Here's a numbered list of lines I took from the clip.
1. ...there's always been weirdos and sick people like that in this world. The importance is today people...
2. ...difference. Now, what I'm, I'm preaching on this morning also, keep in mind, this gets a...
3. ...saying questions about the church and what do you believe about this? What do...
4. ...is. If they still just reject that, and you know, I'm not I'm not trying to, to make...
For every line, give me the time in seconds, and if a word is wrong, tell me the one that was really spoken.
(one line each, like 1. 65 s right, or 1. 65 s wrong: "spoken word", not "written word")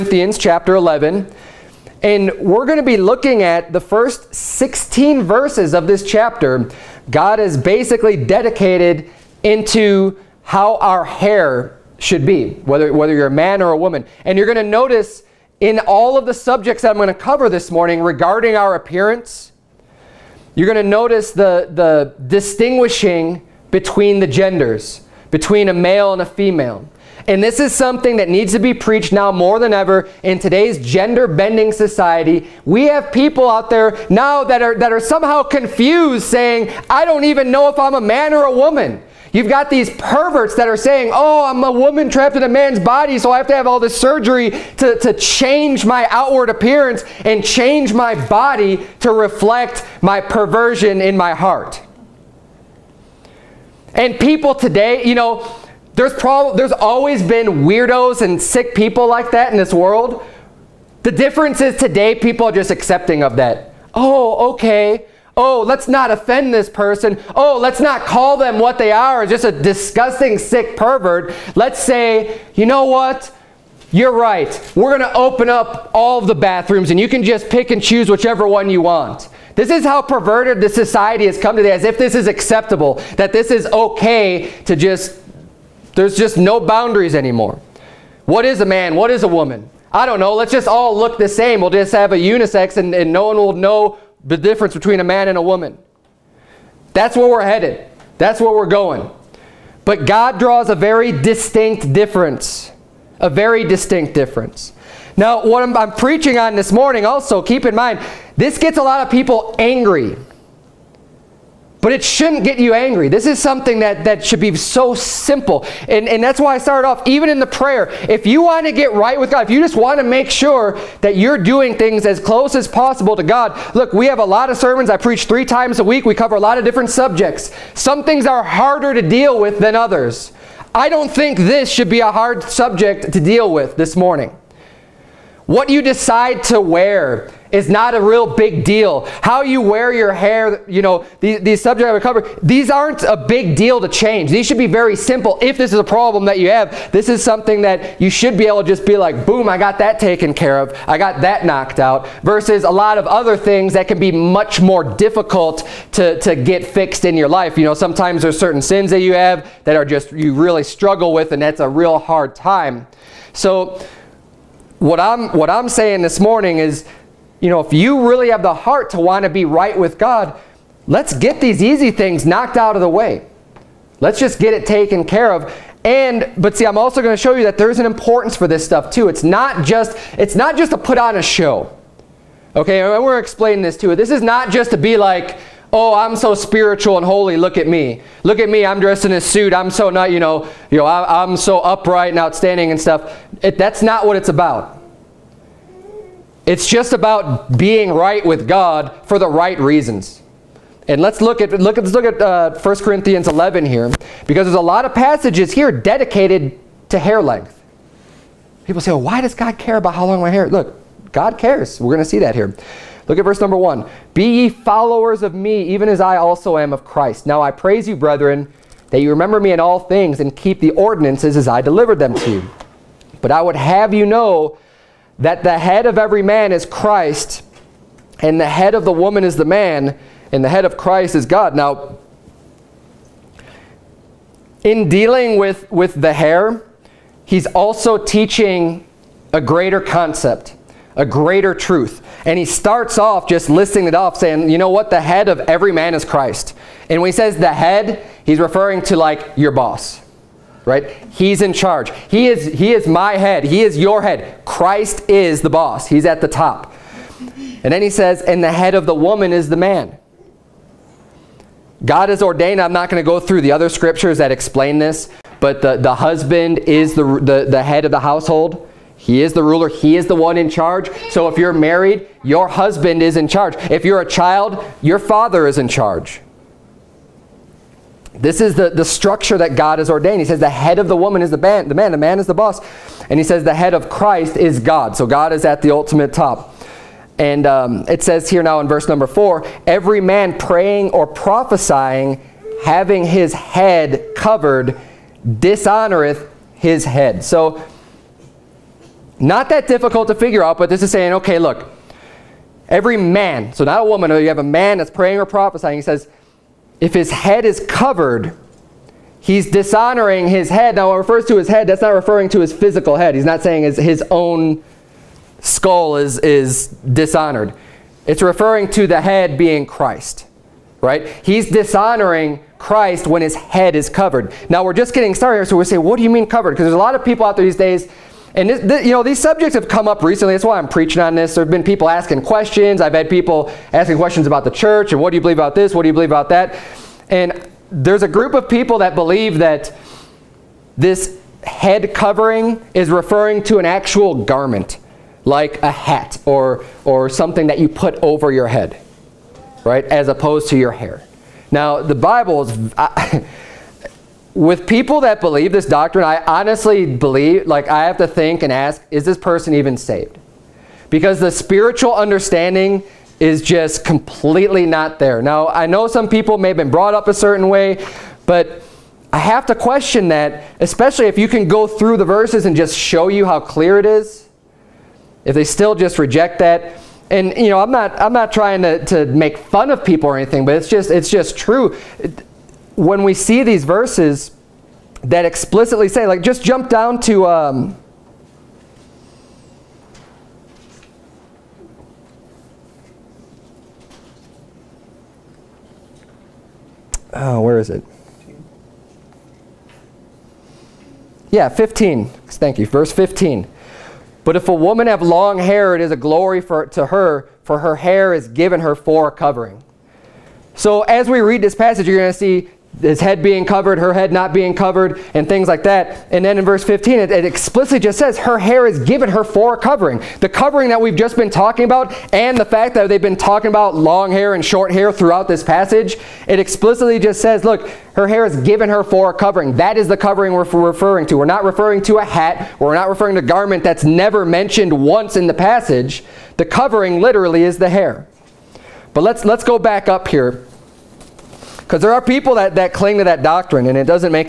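1. 56 s wrong: "difference", not "importance"
2. 104 s right
3. 333 s wrong: "asking", not "saying"
4. 373 s right.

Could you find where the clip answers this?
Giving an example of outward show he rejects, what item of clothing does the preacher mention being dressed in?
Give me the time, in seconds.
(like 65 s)
189 s.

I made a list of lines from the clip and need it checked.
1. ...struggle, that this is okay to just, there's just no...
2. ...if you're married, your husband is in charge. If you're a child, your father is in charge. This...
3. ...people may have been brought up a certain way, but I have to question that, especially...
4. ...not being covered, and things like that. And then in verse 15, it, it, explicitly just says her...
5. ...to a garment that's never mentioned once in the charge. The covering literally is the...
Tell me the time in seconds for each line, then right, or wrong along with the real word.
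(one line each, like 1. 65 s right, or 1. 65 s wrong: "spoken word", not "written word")
1. 82 s wrong: "acceptable", not "struggle"
2. 271 s right
3. 366 s right
4. 414 s right
5. 433 s wrong: "passage", not "charge".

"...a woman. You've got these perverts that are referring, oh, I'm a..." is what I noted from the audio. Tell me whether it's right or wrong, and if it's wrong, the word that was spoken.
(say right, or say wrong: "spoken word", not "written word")
wrong: "saying", not "referring".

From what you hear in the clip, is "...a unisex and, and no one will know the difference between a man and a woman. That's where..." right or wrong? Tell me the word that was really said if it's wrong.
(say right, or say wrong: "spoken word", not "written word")
right.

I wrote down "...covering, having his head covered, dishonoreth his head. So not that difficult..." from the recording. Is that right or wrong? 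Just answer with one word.
wrong.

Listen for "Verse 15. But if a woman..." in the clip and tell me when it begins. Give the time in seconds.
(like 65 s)
402 s.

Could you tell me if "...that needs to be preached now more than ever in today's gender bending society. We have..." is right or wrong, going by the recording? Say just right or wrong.
right.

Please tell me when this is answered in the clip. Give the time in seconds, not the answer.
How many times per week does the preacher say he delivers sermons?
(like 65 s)
125 s.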